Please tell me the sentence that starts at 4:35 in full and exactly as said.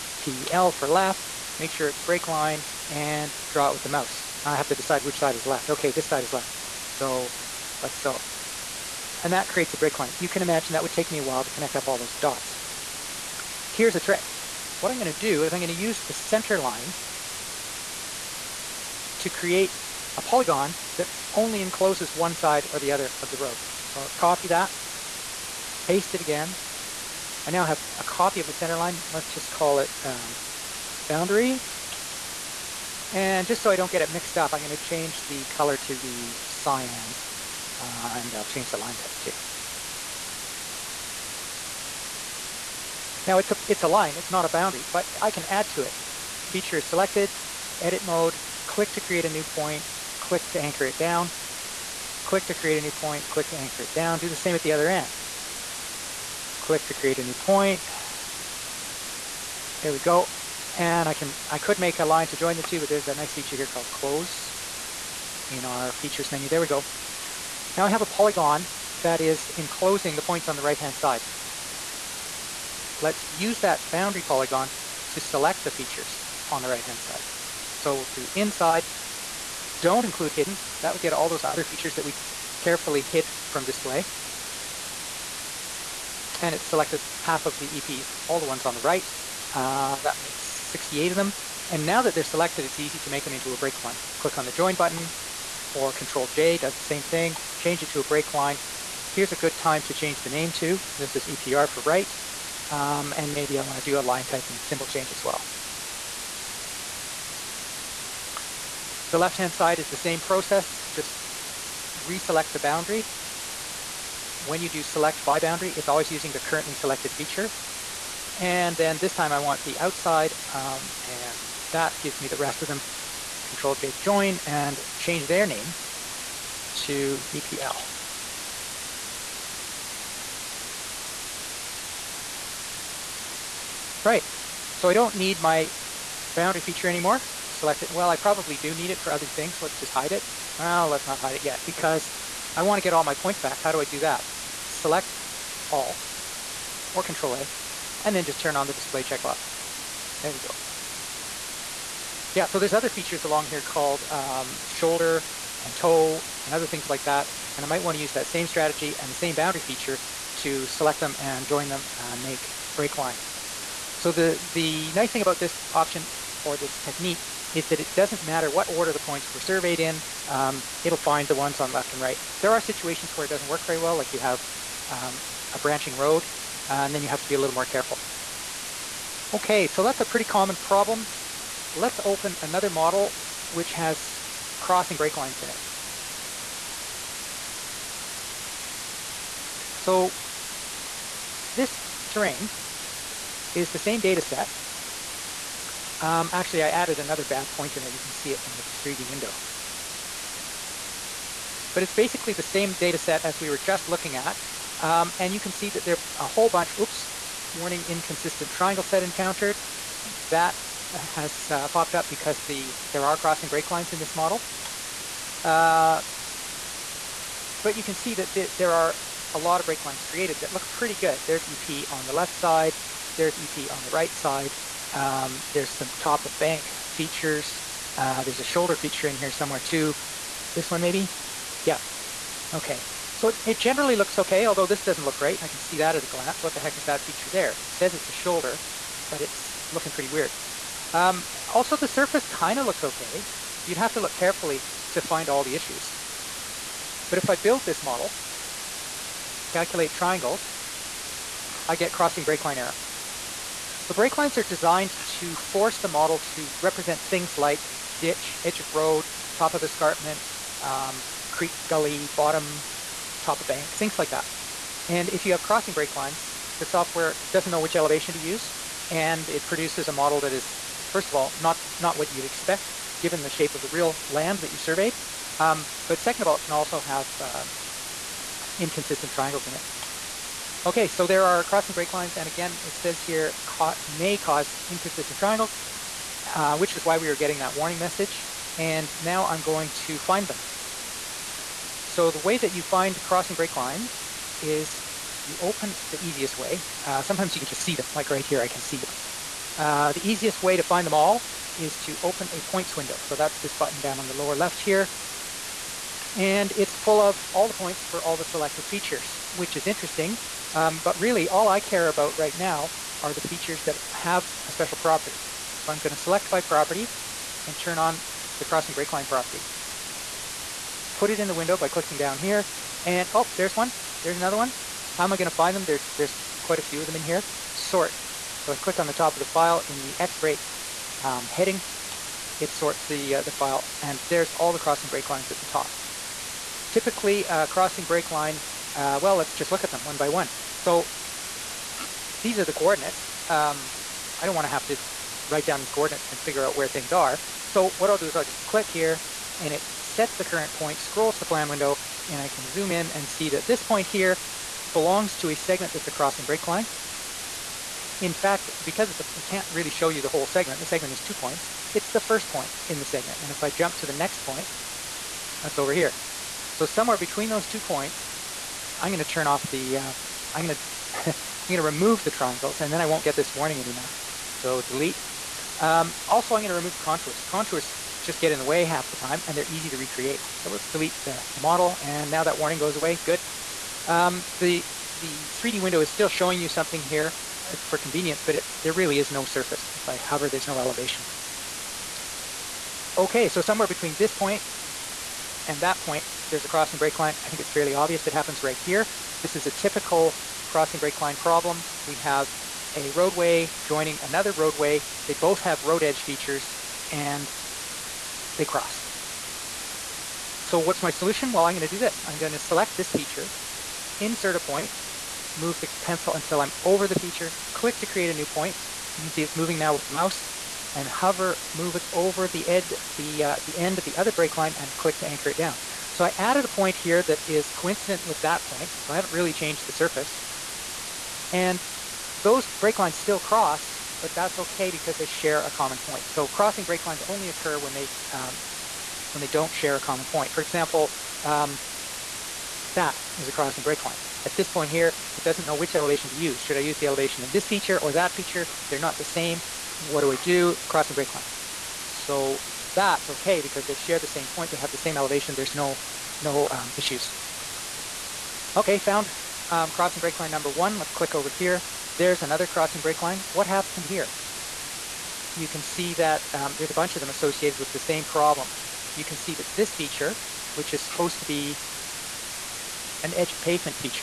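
Um, but second of all, it can also have um, inconsistent triangles in it.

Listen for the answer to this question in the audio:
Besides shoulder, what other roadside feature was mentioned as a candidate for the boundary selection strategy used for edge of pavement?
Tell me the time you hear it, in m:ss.
2:35.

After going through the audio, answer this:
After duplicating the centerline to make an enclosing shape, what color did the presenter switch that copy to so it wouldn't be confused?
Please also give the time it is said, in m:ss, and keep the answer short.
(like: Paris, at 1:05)
cyan, at 0:36.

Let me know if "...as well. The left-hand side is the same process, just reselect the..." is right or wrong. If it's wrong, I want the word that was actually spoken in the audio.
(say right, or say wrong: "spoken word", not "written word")
right.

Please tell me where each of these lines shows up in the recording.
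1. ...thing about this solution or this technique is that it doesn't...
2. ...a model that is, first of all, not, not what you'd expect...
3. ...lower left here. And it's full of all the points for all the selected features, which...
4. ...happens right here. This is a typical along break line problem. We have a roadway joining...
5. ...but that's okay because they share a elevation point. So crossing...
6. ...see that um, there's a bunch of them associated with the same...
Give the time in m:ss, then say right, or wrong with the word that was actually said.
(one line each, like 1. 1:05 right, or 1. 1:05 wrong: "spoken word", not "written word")
1. 2:45 wrong: "option", not "solution"
2. 4:29 right
3. 5:04 right
4. 6:38 wrong: "crossing", not "along"
5. 7:14 wrong: "common", not "elevation"
6. 7:45 right.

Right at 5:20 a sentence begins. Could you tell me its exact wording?
Put it in the window by clicking down here.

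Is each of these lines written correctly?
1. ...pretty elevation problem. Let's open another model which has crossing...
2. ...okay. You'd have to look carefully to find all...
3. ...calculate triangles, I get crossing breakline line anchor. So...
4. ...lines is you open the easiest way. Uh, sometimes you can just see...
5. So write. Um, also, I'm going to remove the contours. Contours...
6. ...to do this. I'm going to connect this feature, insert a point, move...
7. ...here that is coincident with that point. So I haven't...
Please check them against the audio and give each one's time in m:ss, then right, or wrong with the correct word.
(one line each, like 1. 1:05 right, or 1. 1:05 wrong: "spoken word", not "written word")
1. 3:00 wrong: "common", not "elevation"
2. 4:02 right
3. 4:09 wrong: "error", not "anchor"
4. 4:53 right
5. 6:14 wrong: "delete", not "write"
6. 6:51 wrong: "select", not "connect"
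7. 7:06 right.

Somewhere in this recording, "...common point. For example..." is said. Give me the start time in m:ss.
7:19.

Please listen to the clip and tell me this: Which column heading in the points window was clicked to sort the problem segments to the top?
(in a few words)
X break.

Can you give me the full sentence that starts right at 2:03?
Control J join and change their name to EPL.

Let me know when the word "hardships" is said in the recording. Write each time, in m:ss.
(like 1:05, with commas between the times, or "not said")
not said.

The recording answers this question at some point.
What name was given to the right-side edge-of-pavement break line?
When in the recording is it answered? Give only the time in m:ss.
1:41.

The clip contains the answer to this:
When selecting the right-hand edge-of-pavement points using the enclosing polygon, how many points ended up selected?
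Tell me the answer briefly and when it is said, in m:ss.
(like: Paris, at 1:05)
68, at 1:30.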